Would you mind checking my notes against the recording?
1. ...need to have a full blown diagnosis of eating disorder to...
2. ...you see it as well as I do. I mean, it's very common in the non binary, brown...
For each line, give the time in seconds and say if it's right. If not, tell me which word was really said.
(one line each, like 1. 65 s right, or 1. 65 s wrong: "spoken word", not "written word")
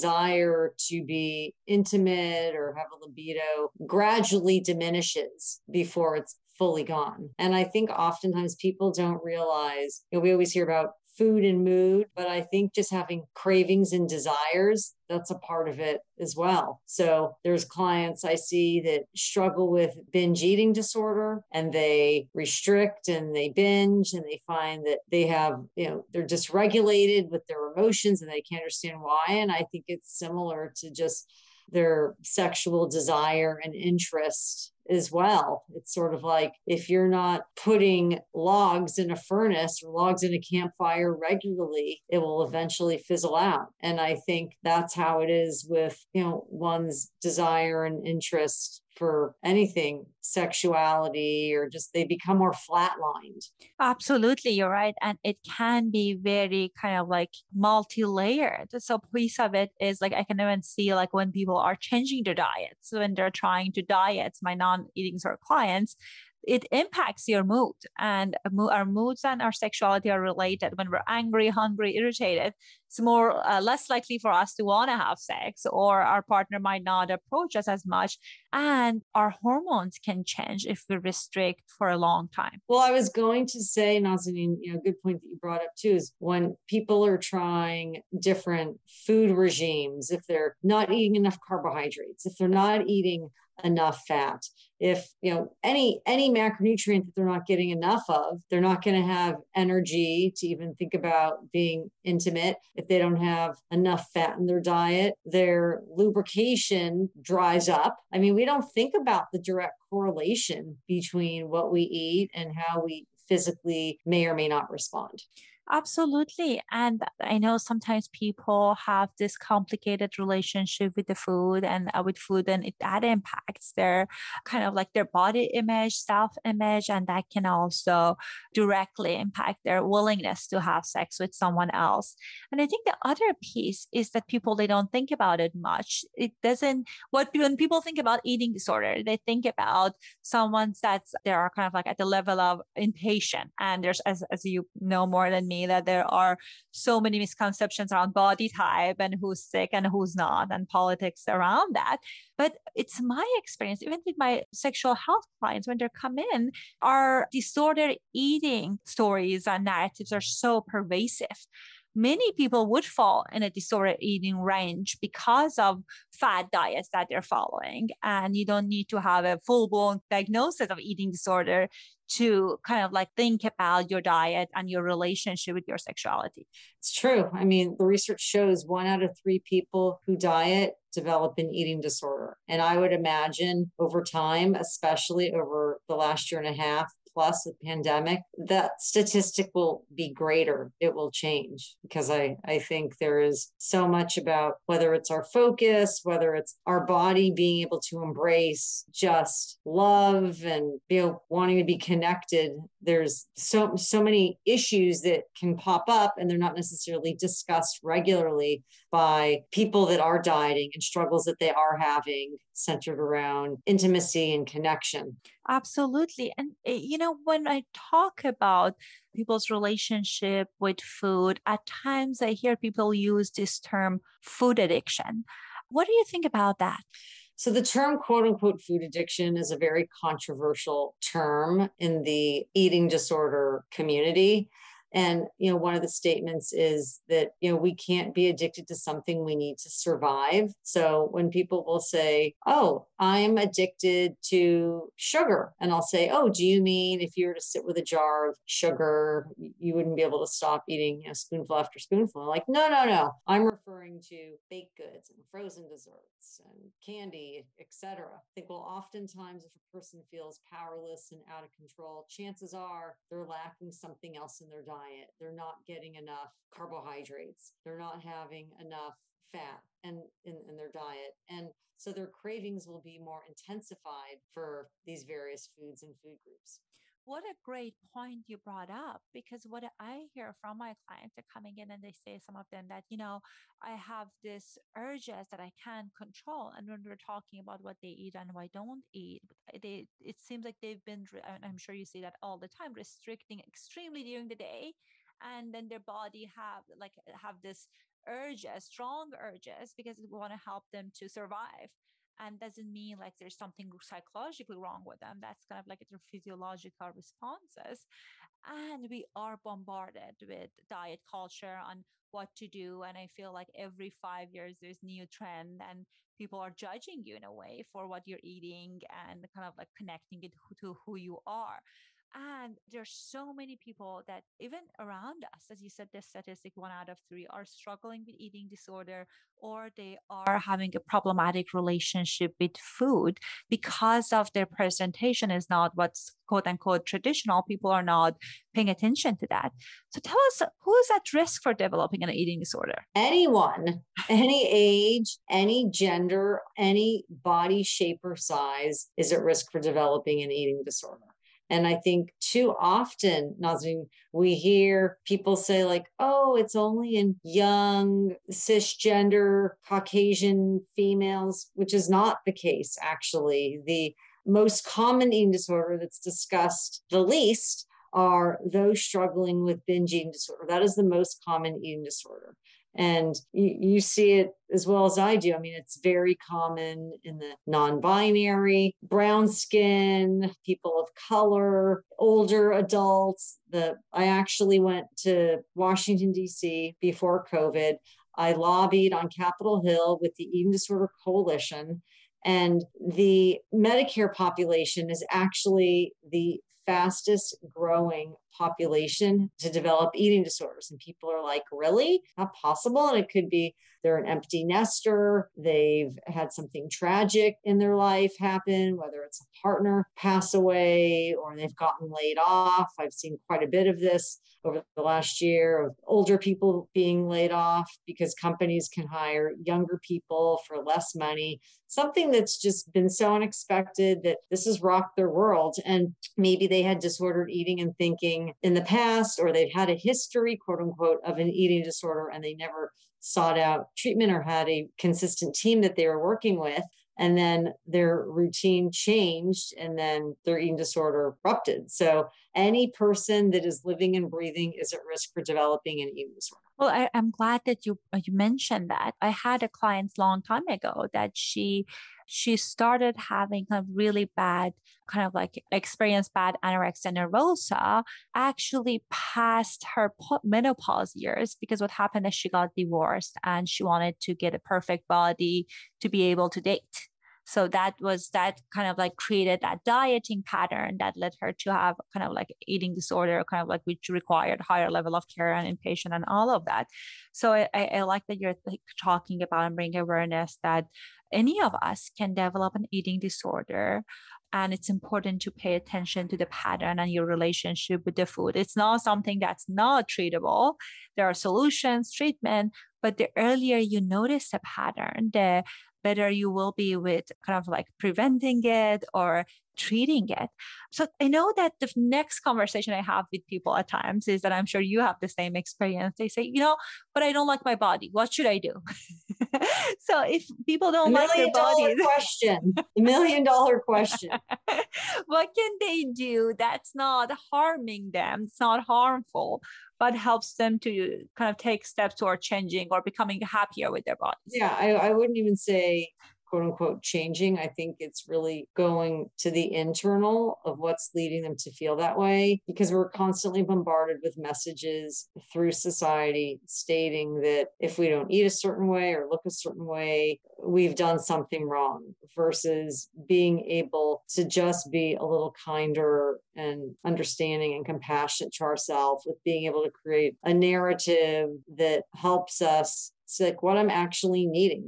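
1. 168 s right
2. 373 s right.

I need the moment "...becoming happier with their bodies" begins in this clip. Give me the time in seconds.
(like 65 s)
522 s.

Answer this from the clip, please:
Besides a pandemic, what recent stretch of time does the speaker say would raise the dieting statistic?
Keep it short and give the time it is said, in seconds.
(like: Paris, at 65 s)
last year and a half, at 185 s.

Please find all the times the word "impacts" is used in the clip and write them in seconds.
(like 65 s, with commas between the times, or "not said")
66 s, 123 s, 129 s.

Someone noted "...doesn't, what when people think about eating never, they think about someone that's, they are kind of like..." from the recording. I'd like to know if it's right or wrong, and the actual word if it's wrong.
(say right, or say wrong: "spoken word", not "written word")
wrong: "disorder", not "never".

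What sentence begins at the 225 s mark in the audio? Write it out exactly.
What do you think about that?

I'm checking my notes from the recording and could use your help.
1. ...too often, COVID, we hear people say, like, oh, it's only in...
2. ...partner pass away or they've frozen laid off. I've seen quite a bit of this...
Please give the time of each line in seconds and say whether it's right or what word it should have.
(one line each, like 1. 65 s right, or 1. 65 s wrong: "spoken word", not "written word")
1. 352 s wrong: "Nazim", not "COVID"
2. 409 s wrong: "gotten", not "frozen".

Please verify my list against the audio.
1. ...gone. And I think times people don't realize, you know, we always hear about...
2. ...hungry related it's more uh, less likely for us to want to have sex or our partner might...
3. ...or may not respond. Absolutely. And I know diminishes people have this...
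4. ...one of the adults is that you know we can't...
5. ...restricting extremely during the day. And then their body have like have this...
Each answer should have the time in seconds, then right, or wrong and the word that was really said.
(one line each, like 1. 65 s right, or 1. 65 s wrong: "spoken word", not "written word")
1. 6 s wrong: "oftentimes", not "times"
2. 71 s wrong: "irritated", not "related"
3. 114 s wrong: "sometimes", not "diminishes"
4. 235 s wrong: "statements", not "adults"
5. 292 s right.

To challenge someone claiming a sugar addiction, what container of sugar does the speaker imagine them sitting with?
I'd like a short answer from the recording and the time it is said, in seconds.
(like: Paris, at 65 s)
jar, at 247 s.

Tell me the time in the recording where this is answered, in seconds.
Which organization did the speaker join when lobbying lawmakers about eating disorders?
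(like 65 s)
390 s.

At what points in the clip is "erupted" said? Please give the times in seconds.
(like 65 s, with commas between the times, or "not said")
441 s.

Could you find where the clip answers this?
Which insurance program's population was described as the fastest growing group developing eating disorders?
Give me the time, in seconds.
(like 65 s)
393 s.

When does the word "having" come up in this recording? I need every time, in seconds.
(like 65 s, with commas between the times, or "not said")
12 s, 211 s, 268 s, 330 s, 453 s.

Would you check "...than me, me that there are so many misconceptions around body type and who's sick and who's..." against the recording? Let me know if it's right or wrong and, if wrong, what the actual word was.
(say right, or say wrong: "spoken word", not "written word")
right.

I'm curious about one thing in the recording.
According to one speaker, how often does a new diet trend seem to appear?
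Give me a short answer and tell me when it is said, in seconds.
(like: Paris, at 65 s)
every five years, at 313 s.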